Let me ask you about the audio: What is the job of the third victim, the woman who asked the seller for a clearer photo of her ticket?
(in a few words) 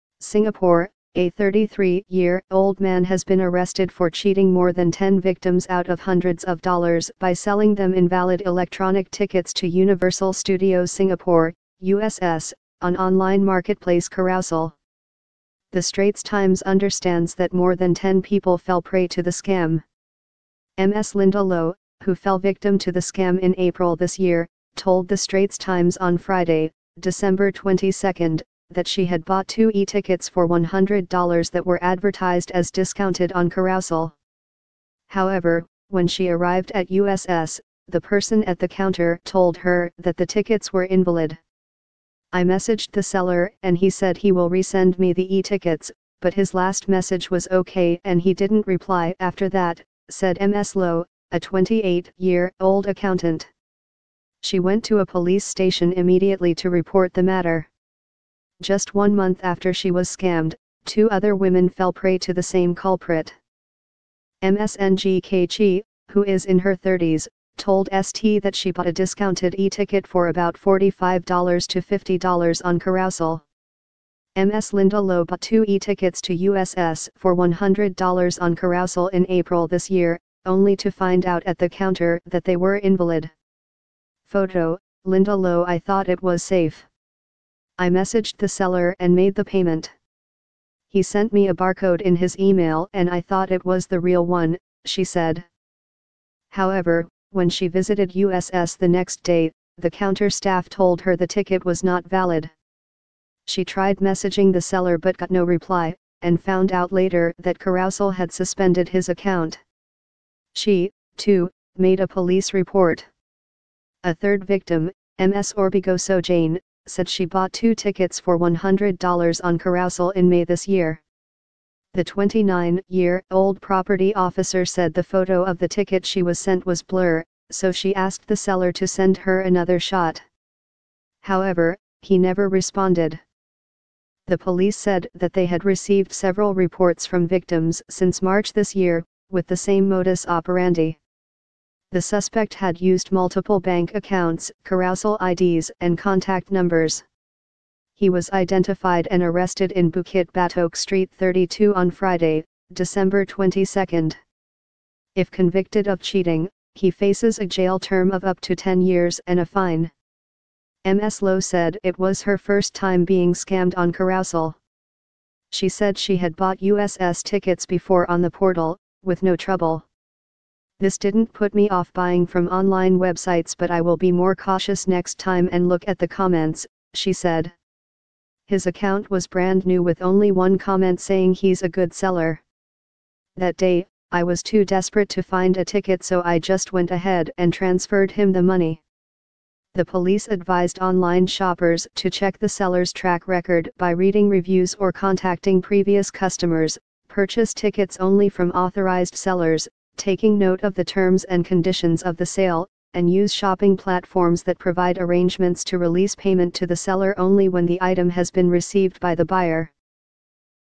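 property officer.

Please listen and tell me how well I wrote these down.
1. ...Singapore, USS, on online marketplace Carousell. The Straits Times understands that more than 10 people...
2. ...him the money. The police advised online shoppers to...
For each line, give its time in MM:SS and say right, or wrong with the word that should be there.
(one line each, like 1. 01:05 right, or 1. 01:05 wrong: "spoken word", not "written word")
1. 00:10 right
2. 03:08 right.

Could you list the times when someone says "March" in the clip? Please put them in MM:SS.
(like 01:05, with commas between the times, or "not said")
02:18.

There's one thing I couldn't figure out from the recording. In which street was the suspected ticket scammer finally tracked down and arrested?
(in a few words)
Bukit Batok Street 32.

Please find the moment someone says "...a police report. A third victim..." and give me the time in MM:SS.
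01:52.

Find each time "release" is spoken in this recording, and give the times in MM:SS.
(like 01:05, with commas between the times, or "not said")
03:25.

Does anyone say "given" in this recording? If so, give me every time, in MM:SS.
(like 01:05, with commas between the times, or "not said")
not said.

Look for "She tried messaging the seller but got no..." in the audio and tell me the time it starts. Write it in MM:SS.
01:43.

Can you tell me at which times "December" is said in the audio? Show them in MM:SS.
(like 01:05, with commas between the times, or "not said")
00:26, 02:32.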